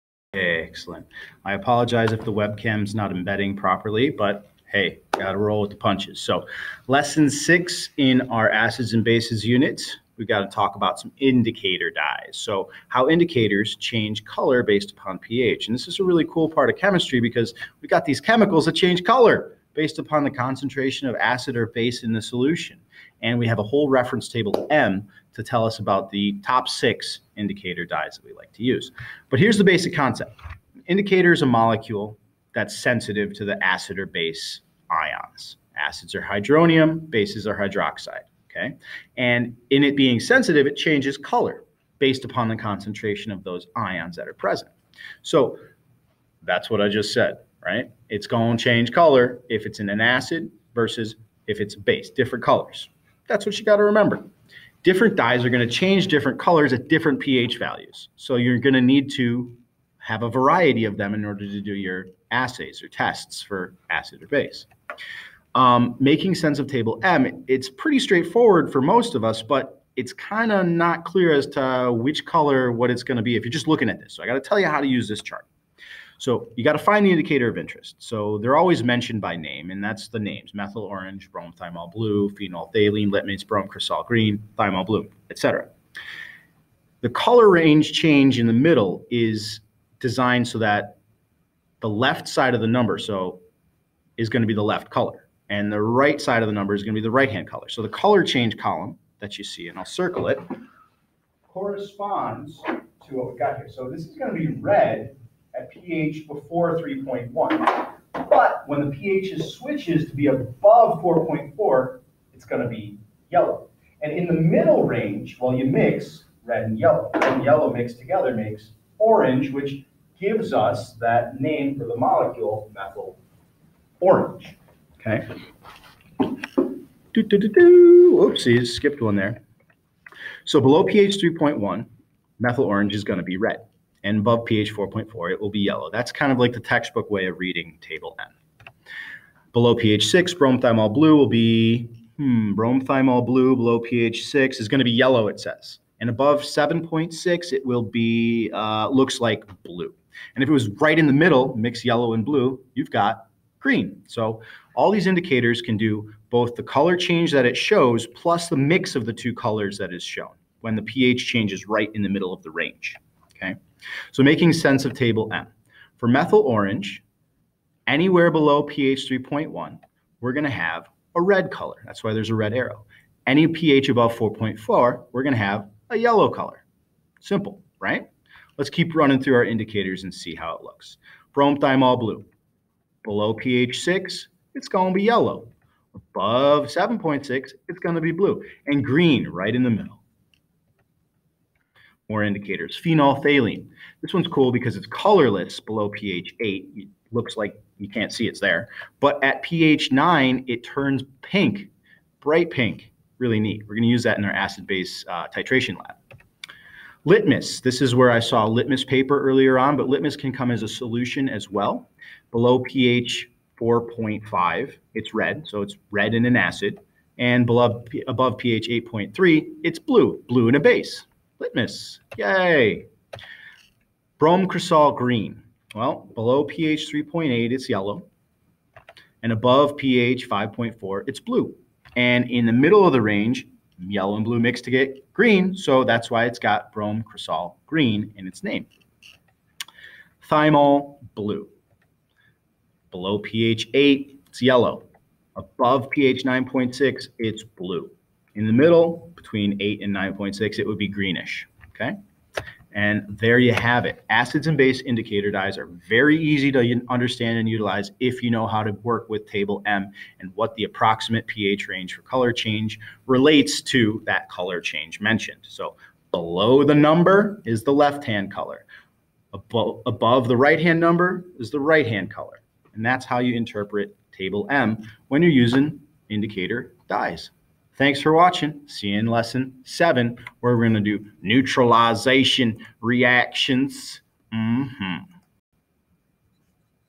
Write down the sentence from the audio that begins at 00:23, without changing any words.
And we have a whole reference table M to tell us about the top six indicator dyes that we like to use.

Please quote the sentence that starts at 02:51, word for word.
That's why there's a red arrow.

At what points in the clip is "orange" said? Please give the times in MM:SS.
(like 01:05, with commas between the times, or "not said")
01:20, 01:58, 02:03, 02:12, 02:46.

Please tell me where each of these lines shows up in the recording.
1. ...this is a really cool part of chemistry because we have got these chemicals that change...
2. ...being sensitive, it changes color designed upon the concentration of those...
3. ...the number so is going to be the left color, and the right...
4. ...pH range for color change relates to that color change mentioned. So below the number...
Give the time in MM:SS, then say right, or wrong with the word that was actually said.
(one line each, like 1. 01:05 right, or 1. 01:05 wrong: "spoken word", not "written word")
1. 00:15 right
2. 00:39 wrong: "based", not "designed"
3. 01:32 right
4. 04:21 right.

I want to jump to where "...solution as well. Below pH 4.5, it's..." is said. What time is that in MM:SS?
03:30.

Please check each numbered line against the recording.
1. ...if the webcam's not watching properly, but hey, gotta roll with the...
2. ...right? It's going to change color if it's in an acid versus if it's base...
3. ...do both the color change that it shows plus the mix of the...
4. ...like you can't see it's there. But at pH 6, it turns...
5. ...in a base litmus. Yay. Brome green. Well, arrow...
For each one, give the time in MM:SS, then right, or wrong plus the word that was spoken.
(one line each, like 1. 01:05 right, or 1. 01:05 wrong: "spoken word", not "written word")
1. 00:02 wrong: "embedding", not "watching"
2. 00:47 right
3. 02:35 right
4. 03:17 wrong: "9", not "6"
5. 03:40 wrong: "below", not "arrow".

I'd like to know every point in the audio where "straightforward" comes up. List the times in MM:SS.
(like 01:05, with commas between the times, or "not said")
01:07.